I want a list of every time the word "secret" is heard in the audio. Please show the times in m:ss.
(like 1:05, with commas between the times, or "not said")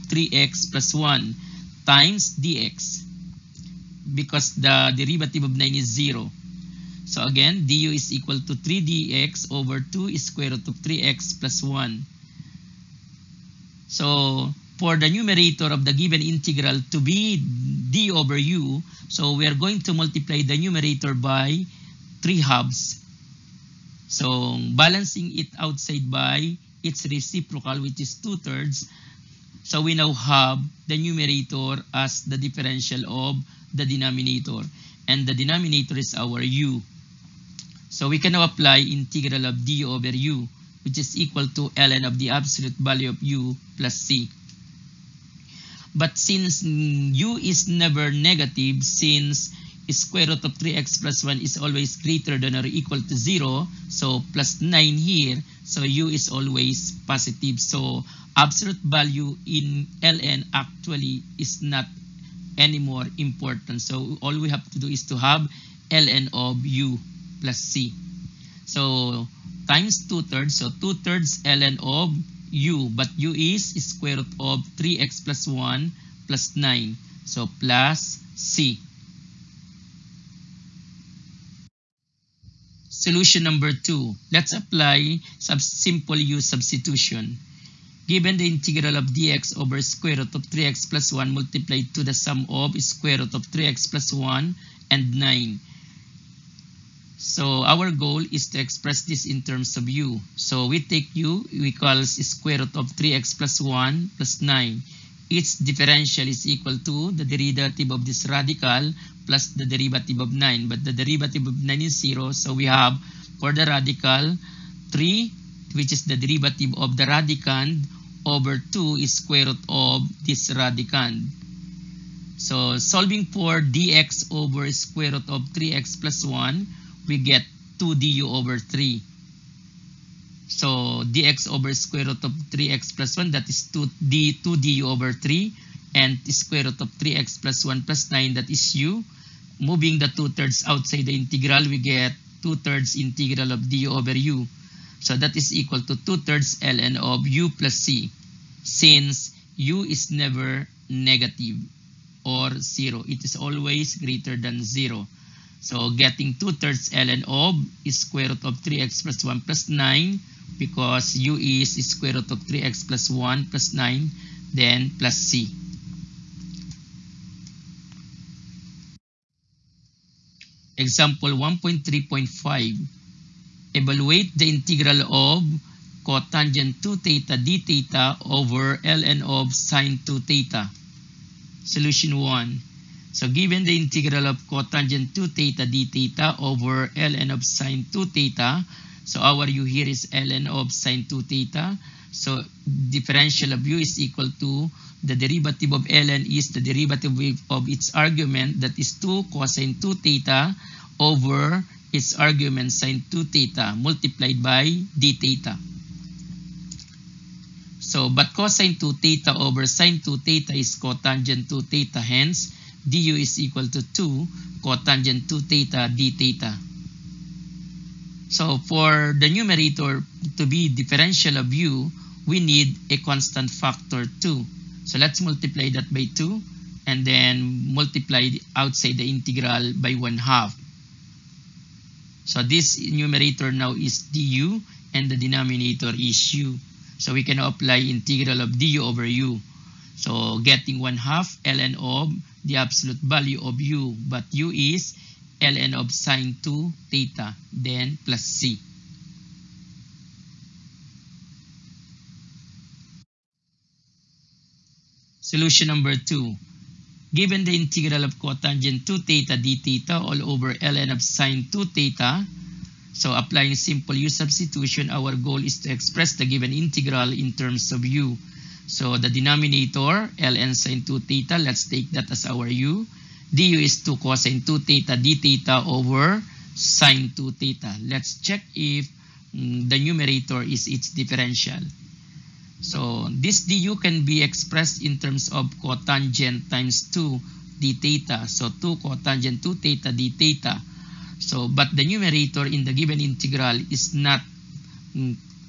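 not said.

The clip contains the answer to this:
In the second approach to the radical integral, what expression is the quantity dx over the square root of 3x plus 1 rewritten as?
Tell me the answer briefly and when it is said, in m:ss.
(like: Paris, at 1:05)
2du/3, at 2:07.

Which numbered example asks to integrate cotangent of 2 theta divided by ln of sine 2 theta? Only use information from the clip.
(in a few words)
Example 1.3.5.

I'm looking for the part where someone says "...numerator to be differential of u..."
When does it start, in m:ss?
3:39.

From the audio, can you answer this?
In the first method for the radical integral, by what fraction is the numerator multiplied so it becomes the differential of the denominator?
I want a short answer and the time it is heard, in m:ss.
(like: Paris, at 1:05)
3/2, at 0:22.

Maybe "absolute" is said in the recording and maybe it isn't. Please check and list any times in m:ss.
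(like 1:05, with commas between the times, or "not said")
0:42, 0:58, 4:02.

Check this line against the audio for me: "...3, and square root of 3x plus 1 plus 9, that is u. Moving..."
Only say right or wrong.
right.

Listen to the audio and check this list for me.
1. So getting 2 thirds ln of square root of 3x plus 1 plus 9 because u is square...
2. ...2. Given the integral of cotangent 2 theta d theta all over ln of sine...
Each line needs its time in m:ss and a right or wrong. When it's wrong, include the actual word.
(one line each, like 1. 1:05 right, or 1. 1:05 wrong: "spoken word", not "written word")
1. 2:35 right
2. 4:15 right.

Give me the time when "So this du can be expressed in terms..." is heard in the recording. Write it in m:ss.
4:42.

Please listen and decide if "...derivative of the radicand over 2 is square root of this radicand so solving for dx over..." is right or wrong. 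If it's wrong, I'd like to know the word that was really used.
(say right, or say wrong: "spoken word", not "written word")
right.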